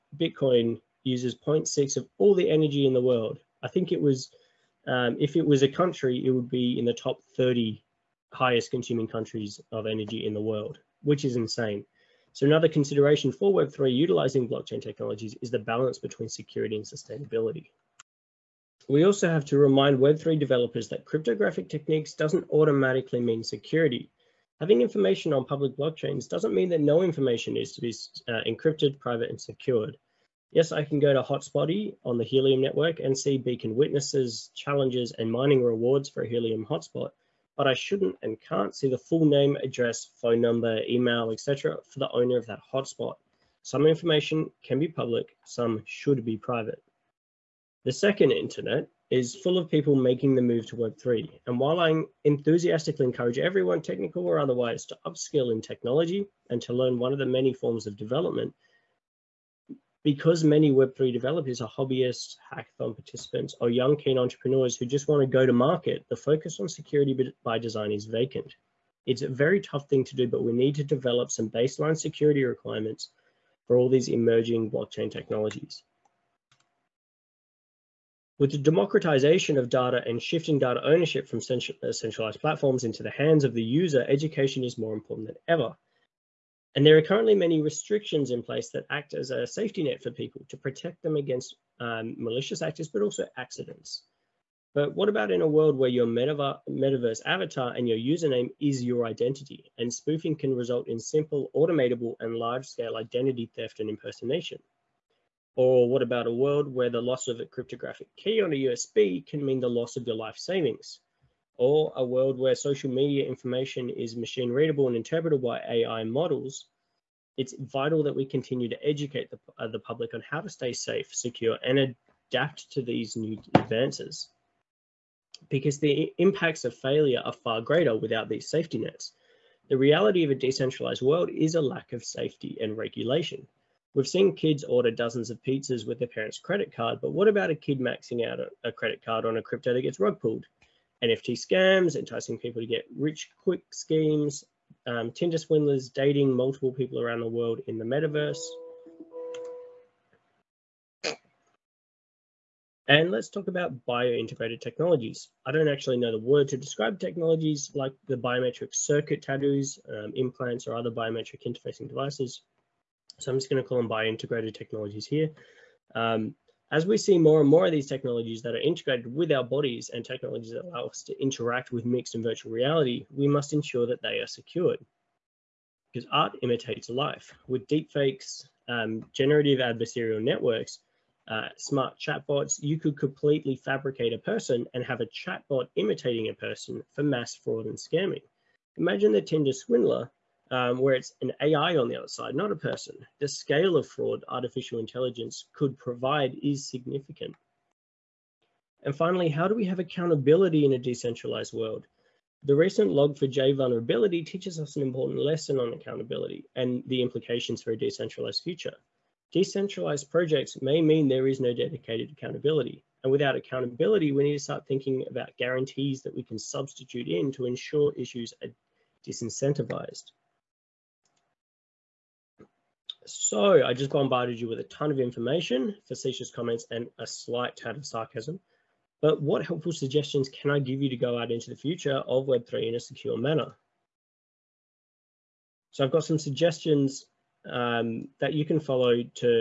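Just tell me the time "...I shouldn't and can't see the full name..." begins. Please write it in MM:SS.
00:37.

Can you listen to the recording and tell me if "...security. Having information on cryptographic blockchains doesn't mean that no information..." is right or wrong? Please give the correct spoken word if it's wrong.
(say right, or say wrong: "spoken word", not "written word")
wrong: "public", not "cryptographic".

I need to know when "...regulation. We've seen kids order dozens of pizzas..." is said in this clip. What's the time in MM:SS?
02:12.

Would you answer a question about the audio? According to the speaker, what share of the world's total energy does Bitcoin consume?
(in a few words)
0.6.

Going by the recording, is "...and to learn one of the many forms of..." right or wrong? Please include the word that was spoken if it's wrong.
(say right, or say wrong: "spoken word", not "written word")
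right.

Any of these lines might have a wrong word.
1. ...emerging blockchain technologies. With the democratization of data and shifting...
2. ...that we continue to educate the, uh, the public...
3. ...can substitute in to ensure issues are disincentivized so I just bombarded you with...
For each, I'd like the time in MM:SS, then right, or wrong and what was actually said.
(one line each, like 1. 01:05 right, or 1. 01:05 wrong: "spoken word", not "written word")
1. 01:14 right
2. 01:58 right
3. 03:36 right.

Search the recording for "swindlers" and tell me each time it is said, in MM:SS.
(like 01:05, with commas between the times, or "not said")
02:25, 03:09.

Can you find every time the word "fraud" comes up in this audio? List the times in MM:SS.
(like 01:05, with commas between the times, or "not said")
03:07, 03:13.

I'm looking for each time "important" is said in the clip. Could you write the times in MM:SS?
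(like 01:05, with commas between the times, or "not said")
01:24, 03:24.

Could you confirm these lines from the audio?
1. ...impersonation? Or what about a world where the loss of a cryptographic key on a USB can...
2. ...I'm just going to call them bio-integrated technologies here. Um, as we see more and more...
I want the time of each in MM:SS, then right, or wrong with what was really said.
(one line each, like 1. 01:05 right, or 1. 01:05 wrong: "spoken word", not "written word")
1. 01:43 right
2. 02:43 right.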